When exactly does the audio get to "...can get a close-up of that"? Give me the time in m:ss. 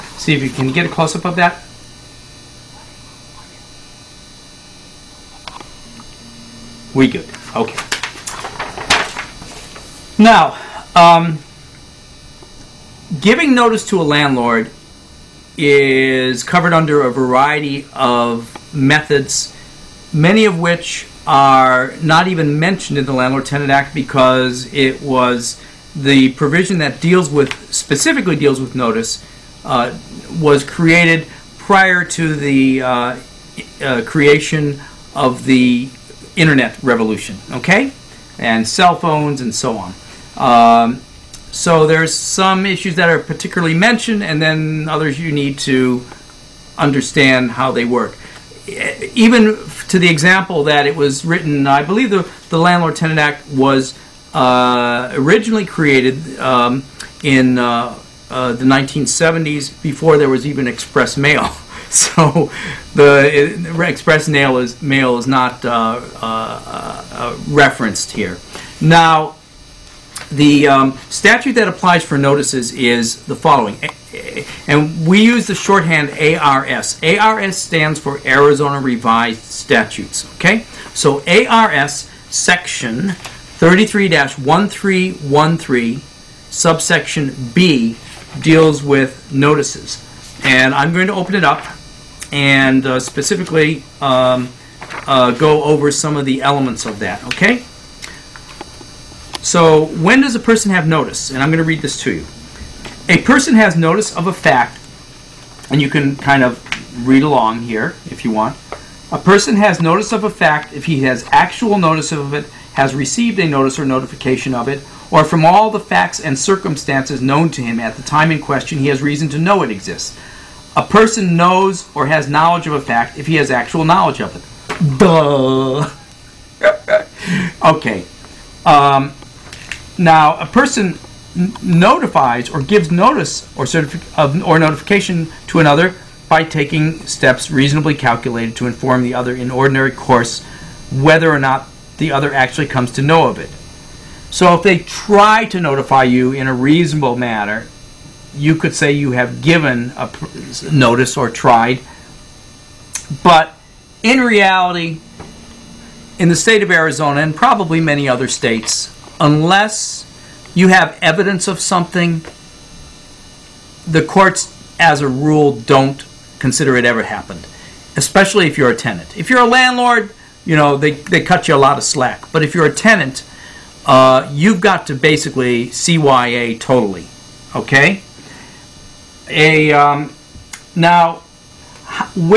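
0:00.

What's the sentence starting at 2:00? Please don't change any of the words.
A person knows or has knowledge of a fact if he has actual knowledge of it.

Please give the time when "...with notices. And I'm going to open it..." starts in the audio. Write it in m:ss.
1:28.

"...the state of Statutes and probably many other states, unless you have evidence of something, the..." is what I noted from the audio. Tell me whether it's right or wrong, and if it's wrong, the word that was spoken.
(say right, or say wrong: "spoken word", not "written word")
wrong: "Arizona", not "Statutes".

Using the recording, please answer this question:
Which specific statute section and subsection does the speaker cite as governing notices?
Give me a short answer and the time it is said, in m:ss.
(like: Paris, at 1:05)
33-1313 subsection B, at 1:23.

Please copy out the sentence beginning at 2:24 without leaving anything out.
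So if they try to notify you in a reasonable manner, you could say you have given a notice or tried.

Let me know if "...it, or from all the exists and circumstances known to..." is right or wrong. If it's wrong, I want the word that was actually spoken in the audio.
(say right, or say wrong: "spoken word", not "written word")
wrong: "facts", not "exists".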